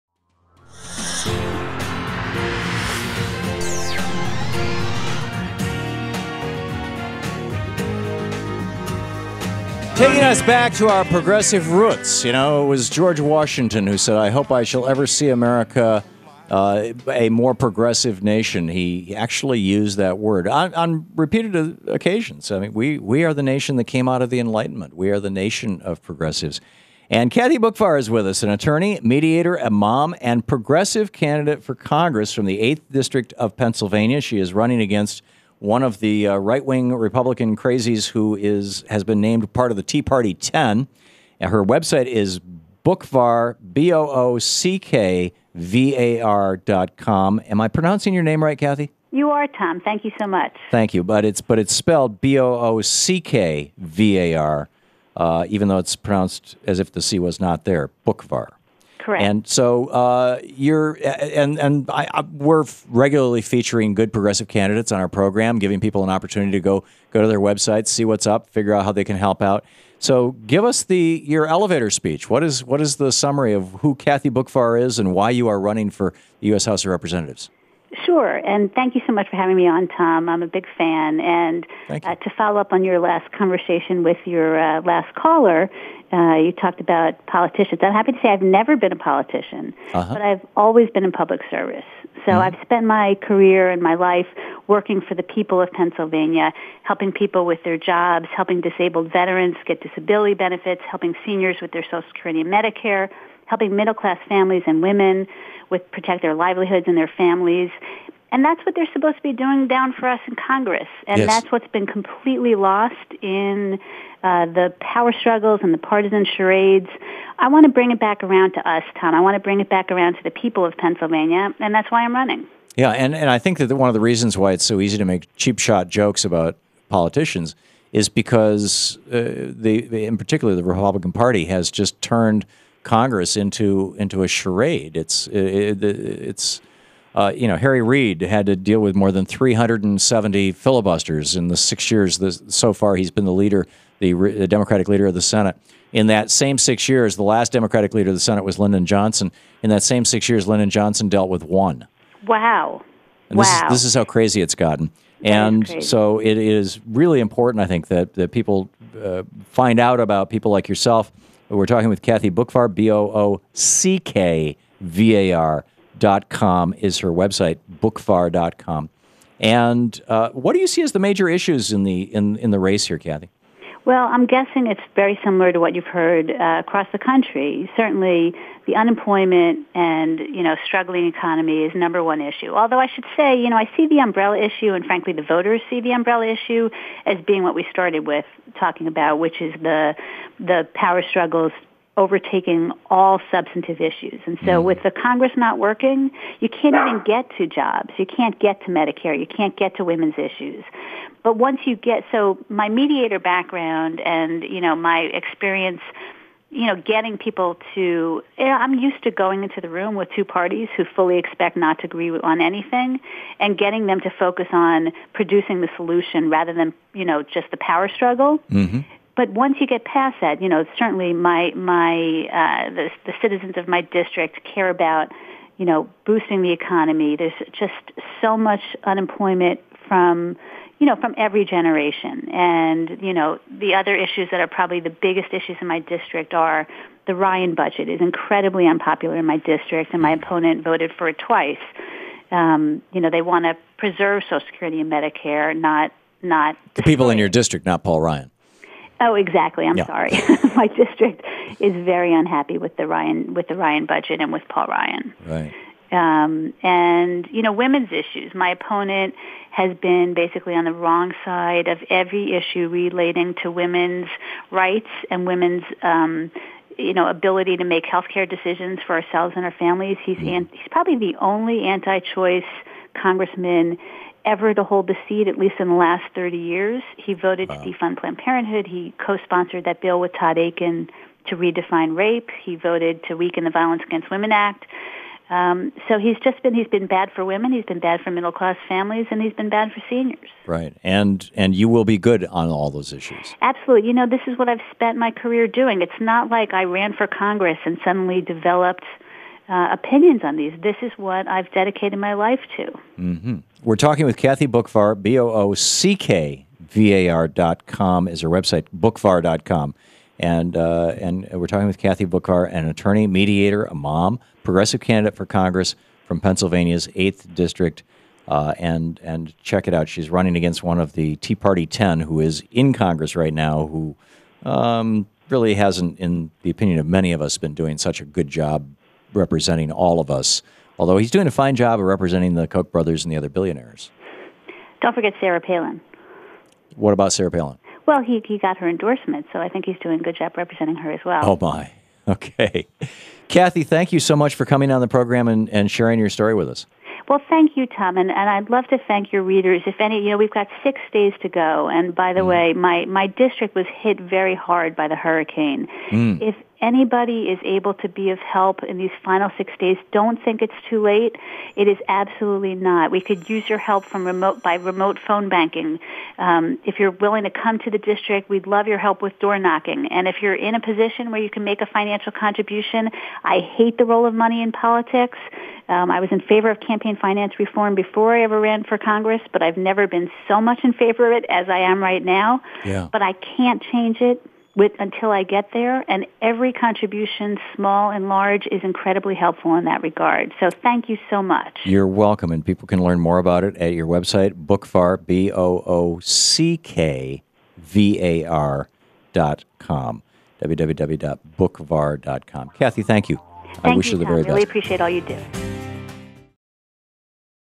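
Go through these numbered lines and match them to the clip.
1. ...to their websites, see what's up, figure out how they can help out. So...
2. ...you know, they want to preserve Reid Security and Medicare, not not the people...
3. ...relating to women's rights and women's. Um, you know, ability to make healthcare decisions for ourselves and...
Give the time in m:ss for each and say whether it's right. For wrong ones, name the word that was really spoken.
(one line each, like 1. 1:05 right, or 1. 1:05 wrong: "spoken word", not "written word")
1. 1:07 right
2. 4:02 wrong: "Social", not "Reid"
3. 4:22 right.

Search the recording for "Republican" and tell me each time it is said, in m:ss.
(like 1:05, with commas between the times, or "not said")
0:36, 2:10.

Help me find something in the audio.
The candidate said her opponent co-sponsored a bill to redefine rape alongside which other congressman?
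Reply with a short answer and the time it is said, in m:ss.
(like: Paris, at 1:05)
Todd Akin, at 4:40.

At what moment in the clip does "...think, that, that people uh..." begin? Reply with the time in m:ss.
2:37.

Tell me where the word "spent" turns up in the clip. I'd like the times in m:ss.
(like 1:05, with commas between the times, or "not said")
1:32, 4:54.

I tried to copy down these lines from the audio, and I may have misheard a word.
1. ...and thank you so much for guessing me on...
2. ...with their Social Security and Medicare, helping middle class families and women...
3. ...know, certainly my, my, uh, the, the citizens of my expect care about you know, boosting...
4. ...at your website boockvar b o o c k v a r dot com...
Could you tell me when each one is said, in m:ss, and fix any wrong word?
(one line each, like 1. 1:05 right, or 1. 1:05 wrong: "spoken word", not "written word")
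1. 1:18 wrong: "having", not "guessing"
2. 1:41 right
3. 3:40 wrong: "district", not "expect"
4. 6:33 right.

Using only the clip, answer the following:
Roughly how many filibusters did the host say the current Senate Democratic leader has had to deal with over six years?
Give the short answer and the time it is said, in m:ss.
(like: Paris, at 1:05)
more than 370, at 2:18.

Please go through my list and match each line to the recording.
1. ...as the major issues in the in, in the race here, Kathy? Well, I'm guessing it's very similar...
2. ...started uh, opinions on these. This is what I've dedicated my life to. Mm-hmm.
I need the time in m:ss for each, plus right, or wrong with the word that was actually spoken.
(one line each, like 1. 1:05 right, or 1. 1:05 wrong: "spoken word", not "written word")
1. 2:50 right
2. 4:58 wrong: "developed", not "started".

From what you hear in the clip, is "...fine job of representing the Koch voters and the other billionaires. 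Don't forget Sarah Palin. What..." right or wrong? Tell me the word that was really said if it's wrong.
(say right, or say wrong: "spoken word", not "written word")
wrong: "brothers", not "voters".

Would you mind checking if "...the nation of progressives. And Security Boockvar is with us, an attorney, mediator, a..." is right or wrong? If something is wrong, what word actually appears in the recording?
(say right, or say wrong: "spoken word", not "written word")
wrong: "Kathy", not "Security".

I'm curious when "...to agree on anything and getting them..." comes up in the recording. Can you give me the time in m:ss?
3:31.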